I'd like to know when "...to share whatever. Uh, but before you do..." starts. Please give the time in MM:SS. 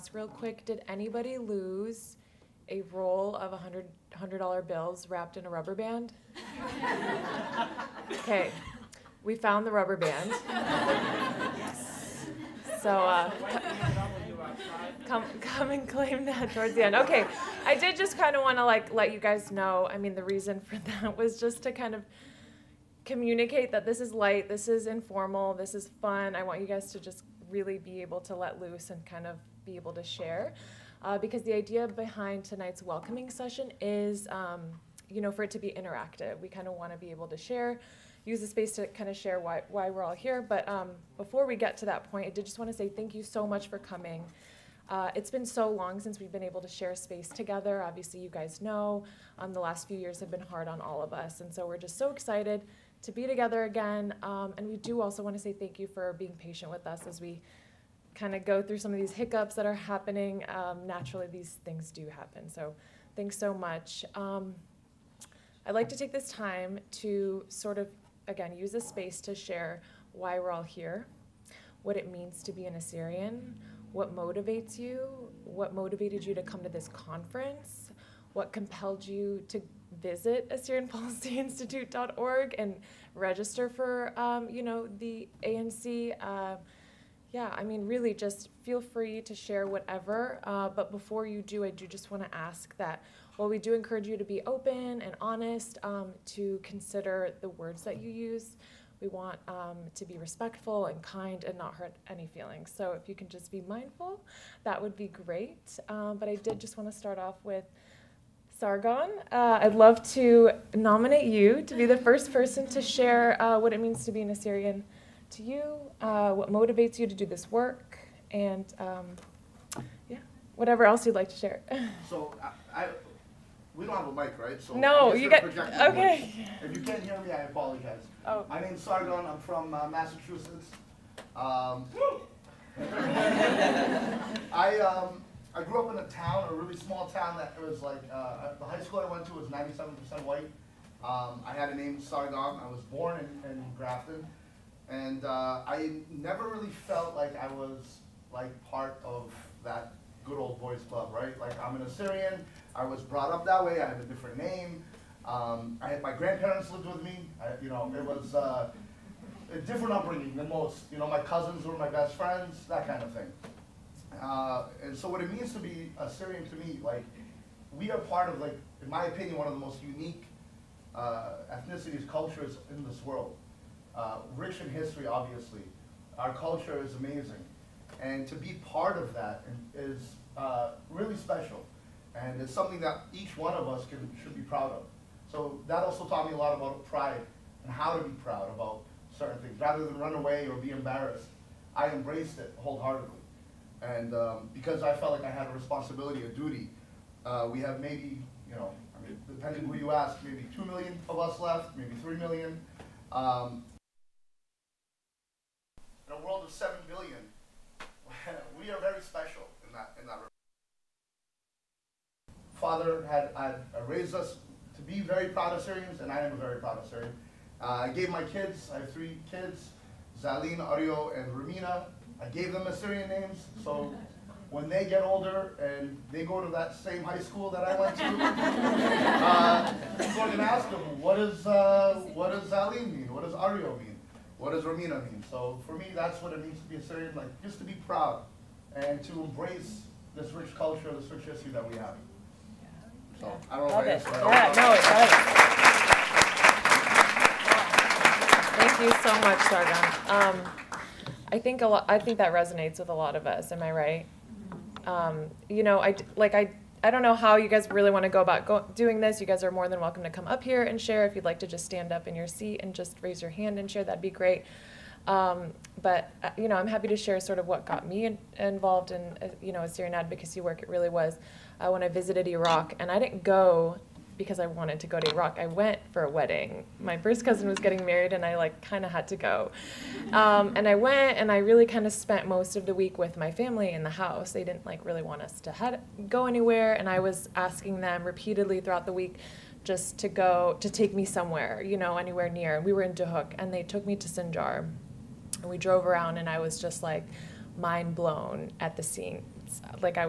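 01:29.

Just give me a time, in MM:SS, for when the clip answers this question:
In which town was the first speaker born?
02:23.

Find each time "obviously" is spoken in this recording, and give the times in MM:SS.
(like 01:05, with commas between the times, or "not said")
00:47, 02:55.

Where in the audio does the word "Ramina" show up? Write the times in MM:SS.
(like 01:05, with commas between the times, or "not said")
03:41, 03:54.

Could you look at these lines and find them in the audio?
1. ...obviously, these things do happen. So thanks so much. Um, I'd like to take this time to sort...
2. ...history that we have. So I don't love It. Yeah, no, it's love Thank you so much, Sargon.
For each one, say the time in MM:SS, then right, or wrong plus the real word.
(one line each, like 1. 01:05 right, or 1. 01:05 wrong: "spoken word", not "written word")
1. 01:00 wrong: "naturally", not "obviously"
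2. 04:01 right.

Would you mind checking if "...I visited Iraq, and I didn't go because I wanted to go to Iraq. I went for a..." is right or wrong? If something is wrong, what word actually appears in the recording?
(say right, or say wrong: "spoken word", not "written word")
right.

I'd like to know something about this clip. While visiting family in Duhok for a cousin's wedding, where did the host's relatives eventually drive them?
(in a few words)
Sinjar.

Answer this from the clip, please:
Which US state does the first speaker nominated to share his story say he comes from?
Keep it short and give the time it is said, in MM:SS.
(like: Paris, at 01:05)
Massachusetts, at 02:09.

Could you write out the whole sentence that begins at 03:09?
Rather than run away or be embarrassed, I embraced it wholeheartedly.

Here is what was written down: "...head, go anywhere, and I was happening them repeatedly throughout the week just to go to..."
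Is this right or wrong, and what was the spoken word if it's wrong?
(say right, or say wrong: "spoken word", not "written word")
wrong: "asking", not "happening".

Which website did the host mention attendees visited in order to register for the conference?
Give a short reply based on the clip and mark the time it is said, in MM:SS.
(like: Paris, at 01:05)
AssyrianPolicyInstitute.org, at 01:20.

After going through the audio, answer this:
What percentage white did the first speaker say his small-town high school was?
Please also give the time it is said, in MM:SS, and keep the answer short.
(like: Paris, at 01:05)
97%, at 02:19.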